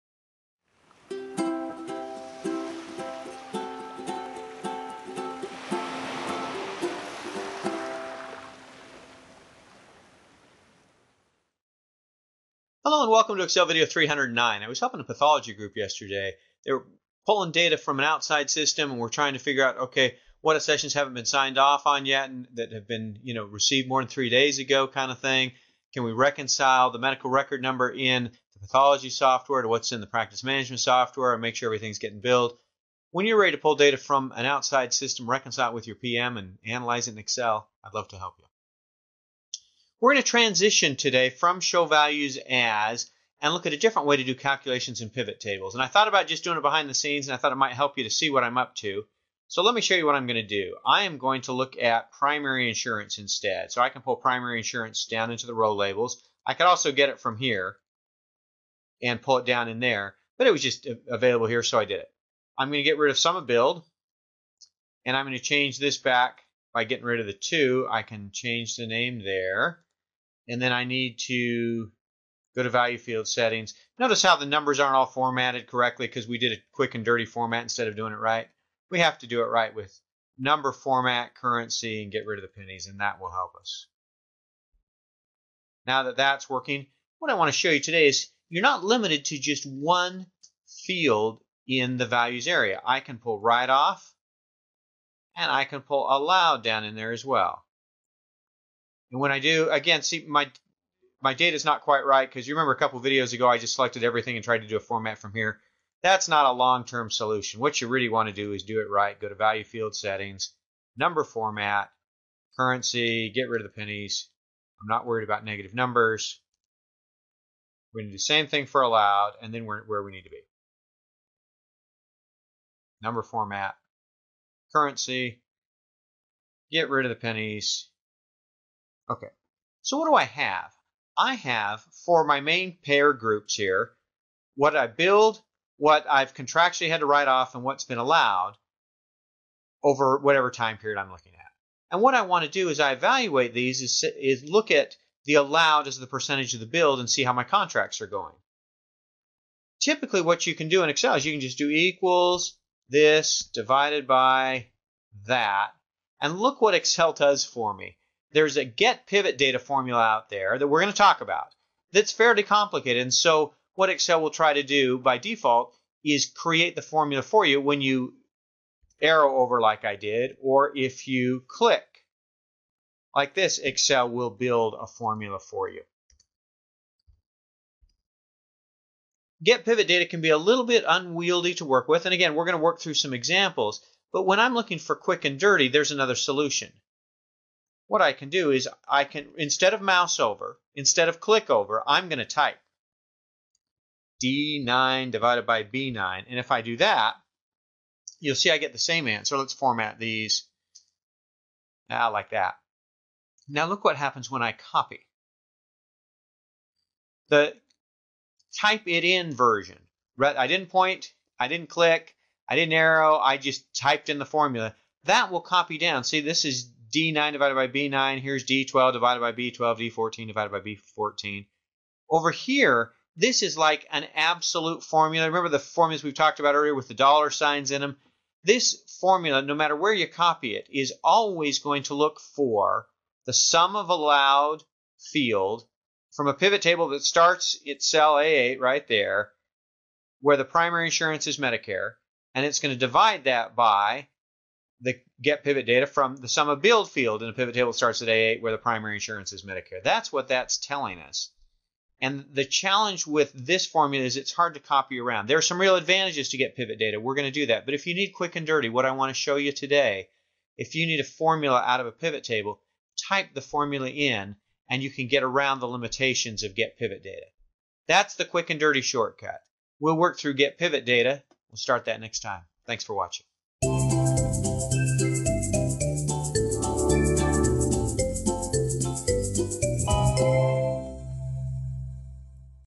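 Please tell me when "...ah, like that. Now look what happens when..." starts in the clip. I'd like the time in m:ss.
3:21.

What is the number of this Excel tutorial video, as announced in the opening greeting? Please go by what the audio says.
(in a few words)
309.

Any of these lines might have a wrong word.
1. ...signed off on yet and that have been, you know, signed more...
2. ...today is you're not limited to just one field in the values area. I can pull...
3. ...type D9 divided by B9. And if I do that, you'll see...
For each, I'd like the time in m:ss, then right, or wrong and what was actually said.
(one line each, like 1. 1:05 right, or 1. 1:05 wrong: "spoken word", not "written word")
1. 0:21 wrong: "received", not "signed"
2. 1:27 right
3. 3:12 right.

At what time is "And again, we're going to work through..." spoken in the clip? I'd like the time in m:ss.
3:02.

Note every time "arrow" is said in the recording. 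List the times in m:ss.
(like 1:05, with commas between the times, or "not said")
2:49, 3:32.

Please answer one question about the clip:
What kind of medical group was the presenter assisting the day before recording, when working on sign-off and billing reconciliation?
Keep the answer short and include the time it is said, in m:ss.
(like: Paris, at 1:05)
Pathology group, at 0:15.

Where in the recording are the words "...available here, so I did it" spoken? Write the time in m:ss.
1:01.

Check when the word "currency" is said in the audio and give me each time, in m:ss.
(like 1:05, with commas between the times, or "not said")
1:21, 1:52, 2:04.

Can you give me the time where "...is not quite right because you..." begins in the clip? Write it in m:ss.
1:41.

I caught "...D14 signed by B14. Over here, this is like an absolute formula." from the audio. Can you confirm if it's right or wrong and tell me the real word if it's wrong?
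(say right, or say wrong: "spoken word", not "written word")
wrong: "divided", not "signed".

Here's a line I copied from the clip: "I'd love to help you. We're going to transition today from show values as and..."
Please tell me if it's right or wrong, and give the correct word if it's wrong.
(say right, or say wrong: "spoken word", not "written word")
right.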